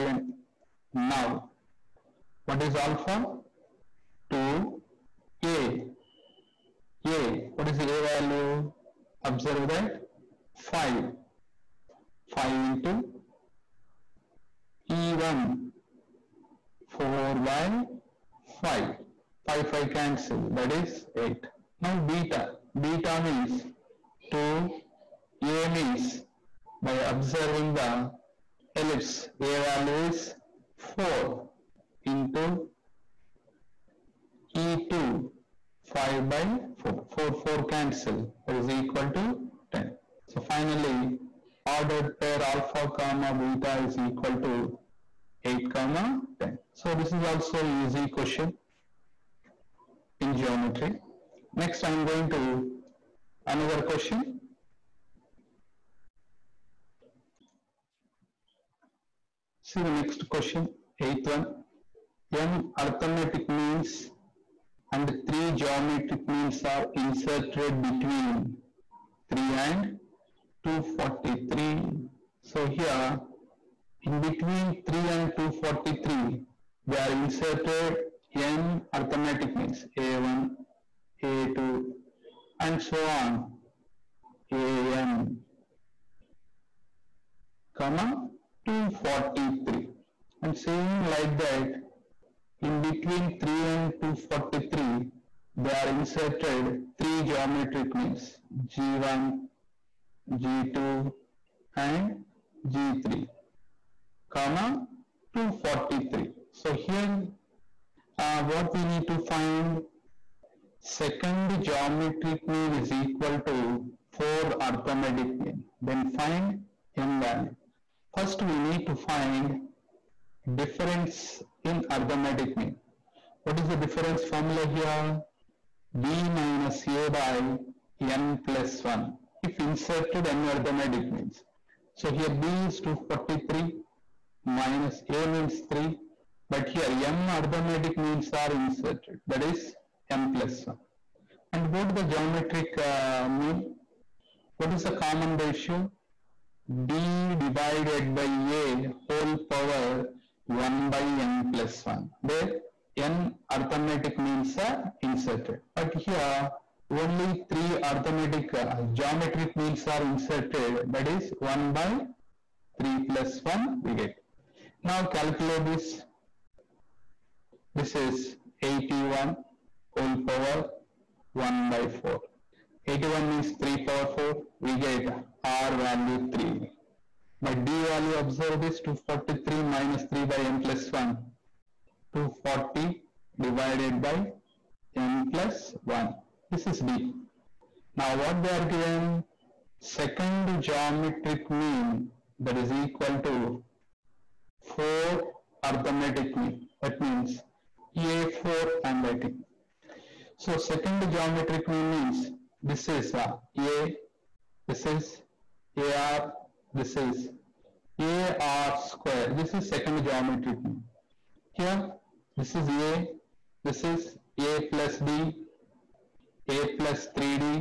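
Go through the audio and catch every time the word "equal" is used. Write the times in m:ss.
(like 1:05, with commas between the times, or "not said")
0:38, 0:43, 1:52, 3:12.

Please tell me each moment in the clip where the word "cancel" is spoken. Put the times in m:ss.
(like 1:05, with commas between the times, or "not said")
0:19, 0:37.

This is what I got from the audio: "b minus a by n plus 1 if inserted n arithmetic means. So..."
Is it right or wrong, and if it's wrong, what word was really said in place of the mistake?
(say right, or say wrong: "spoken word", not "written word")
right.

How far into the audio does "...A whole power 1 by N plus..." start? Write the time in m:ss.
2:28.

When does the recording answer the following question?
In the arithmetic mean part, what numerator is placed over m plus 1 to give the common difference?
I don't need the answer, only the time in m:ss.
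3:01.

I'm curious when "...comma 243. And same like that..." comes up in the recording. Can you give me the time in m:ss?
1:27.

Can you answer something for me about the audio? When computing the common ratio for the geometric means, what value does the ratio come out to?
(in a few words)
3.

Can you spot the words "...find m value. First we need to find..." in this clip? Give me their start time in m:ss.
1:56.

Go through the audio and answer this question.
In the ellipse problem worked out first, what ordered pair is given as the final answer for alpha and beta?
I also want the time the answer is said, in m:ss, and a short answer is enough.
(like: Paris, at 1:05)
(8, 10), at 0:45.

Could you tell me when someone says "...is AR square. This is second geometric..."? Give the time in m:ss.
3:26.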